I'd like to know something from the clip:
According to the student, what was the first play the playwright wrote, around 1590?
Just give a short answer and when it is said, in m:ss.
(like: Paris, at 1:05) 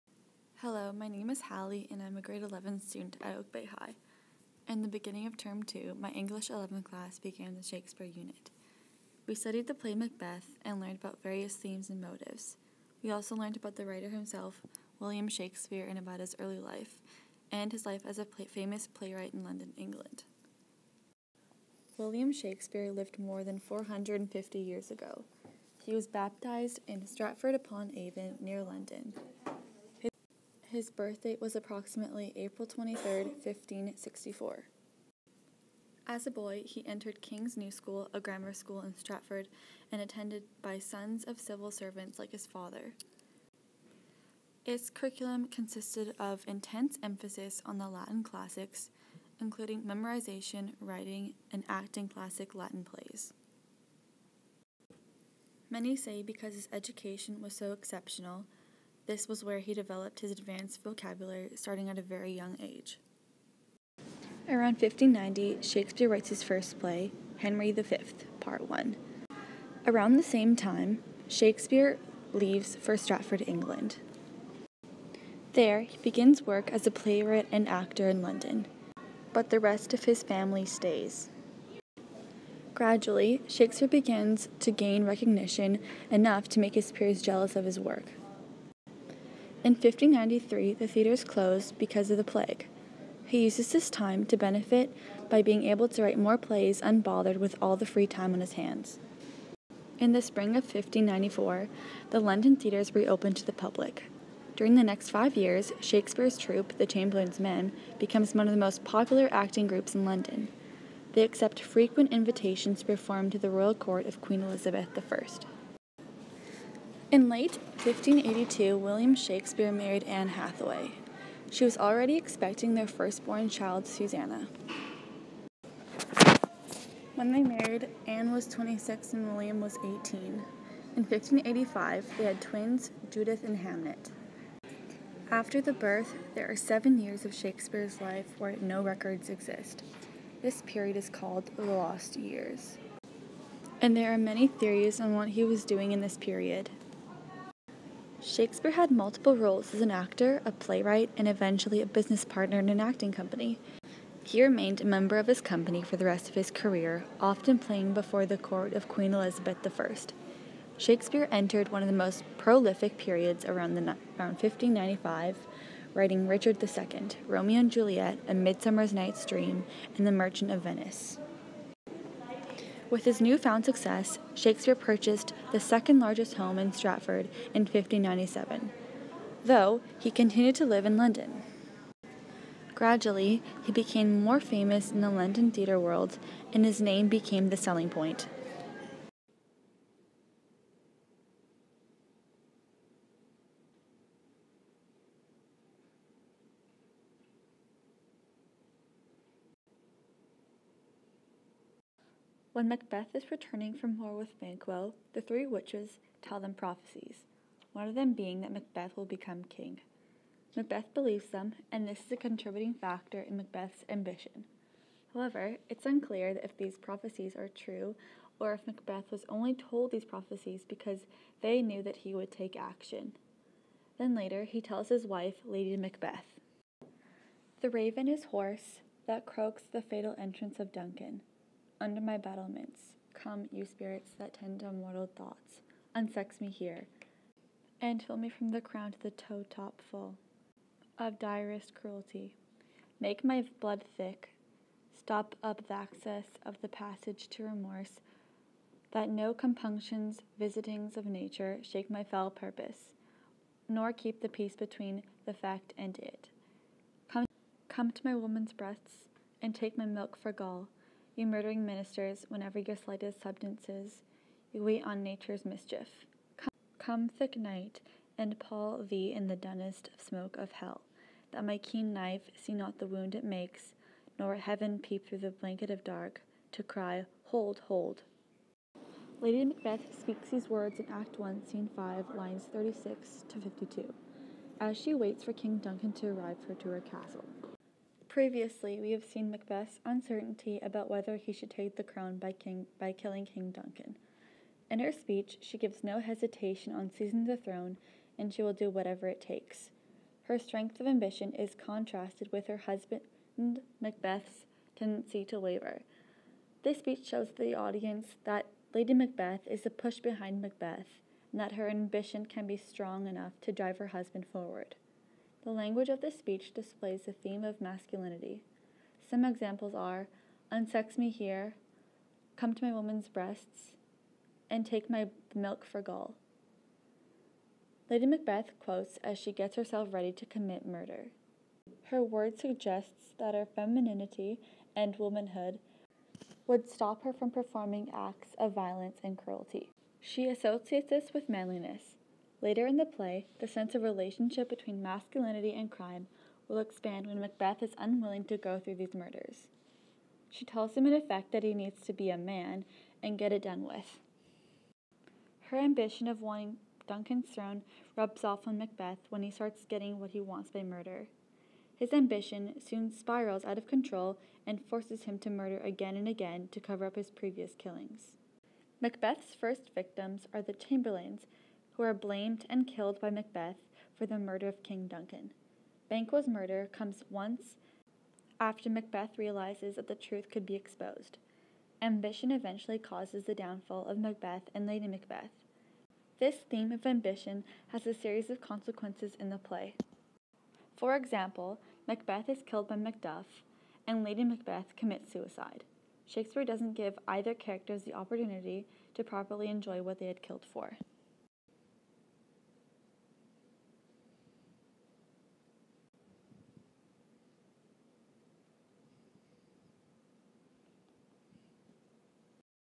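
Henry V, Part 1, at 1:07.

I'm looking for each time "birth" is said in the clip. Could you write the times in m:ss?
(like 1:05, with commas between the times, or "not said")
0:30, 2:15.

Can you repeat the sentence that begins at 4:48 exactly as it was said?
Previously, we have seen Macbeth's uncertainty about whether he should take the crown by, King, by killing King Duncan.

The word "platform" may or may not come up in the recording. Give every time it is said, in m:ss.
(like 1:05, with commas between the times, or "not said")
not said.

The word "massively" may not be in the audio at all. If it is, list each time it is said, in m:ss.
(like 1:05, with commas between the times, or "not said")
not said.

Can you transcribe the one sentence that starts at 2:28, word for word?
Shakespeare had multiple roles as an actor, a playwright, and eventually a business partner in an acting company.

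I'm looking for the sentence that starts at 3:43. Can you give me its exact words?
Then later, he tells his wife, Lady Macbeth.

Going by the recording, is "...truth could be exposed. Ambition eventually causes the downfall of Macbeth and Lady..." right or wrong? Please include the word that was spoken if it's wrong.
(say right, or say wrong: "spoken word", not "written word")
right.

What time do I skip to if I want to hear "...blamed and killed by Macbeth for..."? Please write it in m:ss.
6:11.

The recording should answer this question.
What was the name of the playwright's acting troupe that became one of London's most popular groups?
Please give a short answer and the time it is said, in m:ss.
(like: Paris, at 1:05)
The Chamberlain's Men, at 1:46.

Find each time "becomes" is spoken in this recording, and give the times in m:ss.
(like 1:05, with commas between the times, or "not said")
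1:47, 3:29.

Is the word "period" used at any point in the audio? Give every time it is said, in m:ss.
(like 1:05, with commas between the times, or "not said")
2:20, 2:26, 2:42.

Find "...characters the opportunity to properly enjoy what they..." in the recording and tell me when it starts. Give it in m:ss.
6:37.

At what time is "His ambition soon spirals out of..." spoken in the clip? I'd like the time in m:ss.
6:01.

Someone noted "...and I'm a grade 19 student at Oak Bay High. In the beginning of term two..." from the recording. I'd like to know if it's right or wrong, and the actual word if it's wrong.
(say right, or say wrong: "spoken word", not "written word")
wrong: "11", not "19".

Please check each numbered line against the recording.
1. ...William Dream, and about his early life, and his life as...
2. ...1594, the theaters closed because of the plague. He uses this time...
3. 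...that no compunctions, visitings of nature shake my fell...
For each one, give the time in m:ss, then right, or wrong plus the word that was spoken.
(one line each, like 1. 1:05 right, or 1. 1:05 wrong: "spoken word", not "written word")
1. 0:14 wrong: "Shakespeare", not "Dream"
2. 1:29 wrong: "1593", not "1594"
3. 4:08 right.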